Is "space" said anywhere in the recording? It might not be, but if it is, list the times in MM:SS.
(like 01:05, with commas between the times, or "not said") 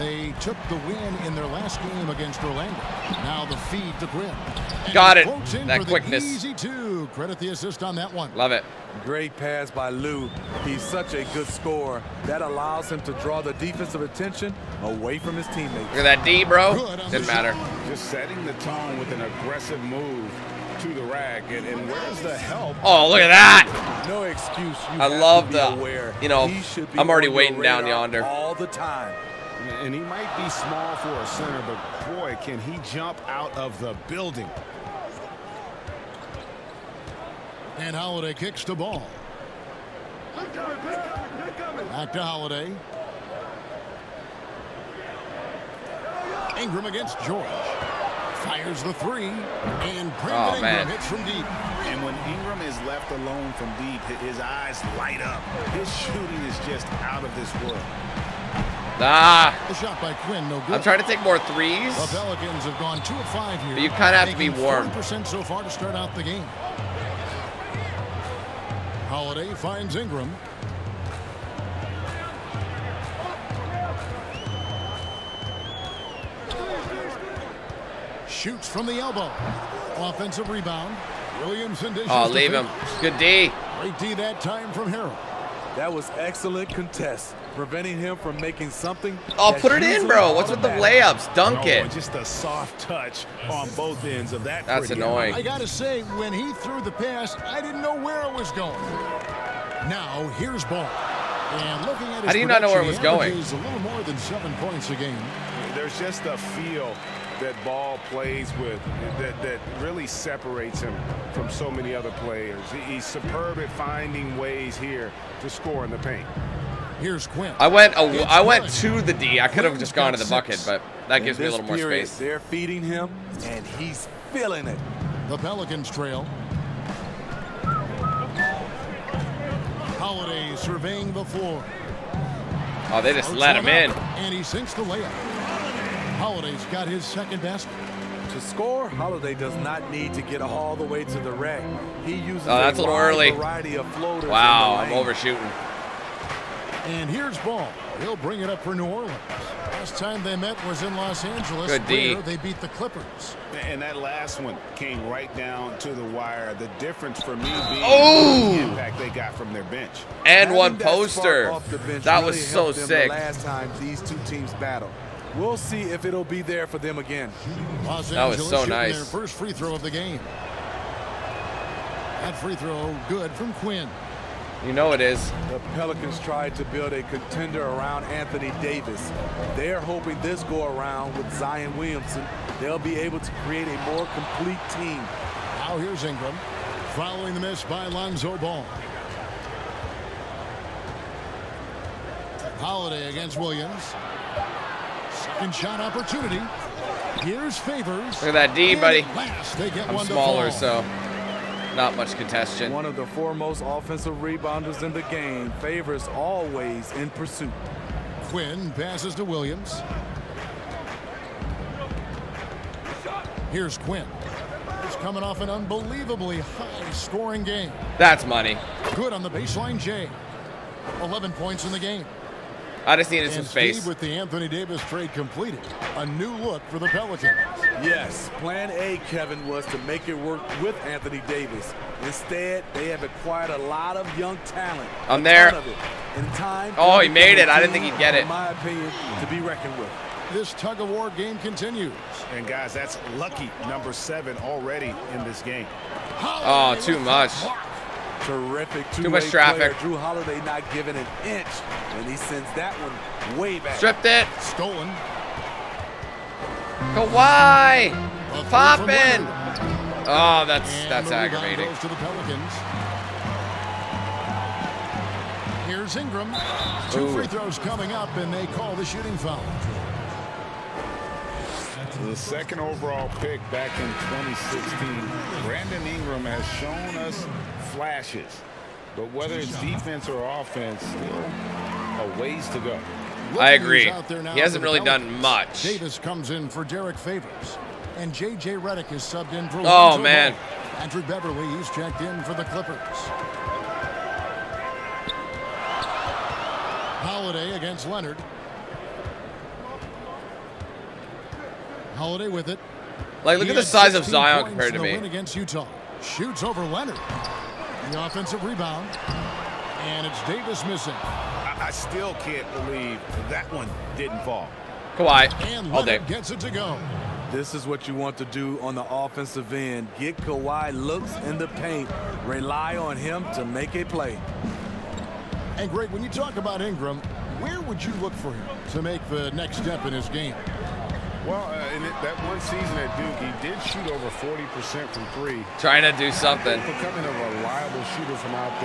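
02:02, 03:43.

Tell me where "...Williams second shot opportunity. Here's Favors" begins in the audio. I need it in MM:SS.
03:13.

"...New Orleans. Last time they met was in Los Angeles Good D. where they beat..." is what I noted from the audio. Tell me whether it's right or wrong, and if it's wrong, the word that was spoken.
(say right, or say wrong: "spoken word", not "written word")
right.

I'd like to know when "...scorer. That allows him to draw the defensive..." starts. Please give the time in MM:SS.
00:11.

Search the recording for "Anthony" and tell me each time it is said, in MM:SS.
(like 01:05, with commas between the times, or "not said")
02:58, 03:44, 03:50.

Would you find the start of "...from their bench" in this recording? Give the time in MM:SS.
02:39.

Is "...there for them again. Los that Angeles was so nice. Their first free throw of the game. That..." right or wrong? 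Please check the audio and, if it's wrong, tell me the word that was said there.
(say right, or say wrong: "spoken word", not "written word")
right.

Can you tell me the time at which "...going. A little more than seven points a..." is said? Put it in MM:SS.
01:42.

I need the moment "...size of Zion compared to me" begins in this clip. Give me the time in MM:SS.
05:03.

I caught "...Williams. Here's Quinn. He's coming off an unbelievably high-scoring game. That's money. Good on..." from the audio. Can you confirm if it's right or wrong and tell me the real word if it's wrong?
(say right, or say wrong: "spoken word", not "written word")
right.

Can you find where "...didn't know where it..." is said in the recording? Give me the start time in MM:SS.
01:37.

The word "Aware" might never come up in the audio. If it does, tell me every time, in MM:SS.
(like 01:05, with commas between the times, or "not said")
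00:25.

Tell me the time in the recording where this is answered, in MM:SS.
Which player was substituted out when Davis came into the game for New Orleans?
04:46.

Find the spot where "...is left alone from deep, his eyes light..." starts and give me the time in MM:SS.
00:52.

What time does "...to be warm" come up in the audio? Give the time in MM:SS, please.
01:04.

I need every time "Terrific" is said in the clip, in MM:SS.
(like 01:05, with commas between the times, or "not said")
04:08.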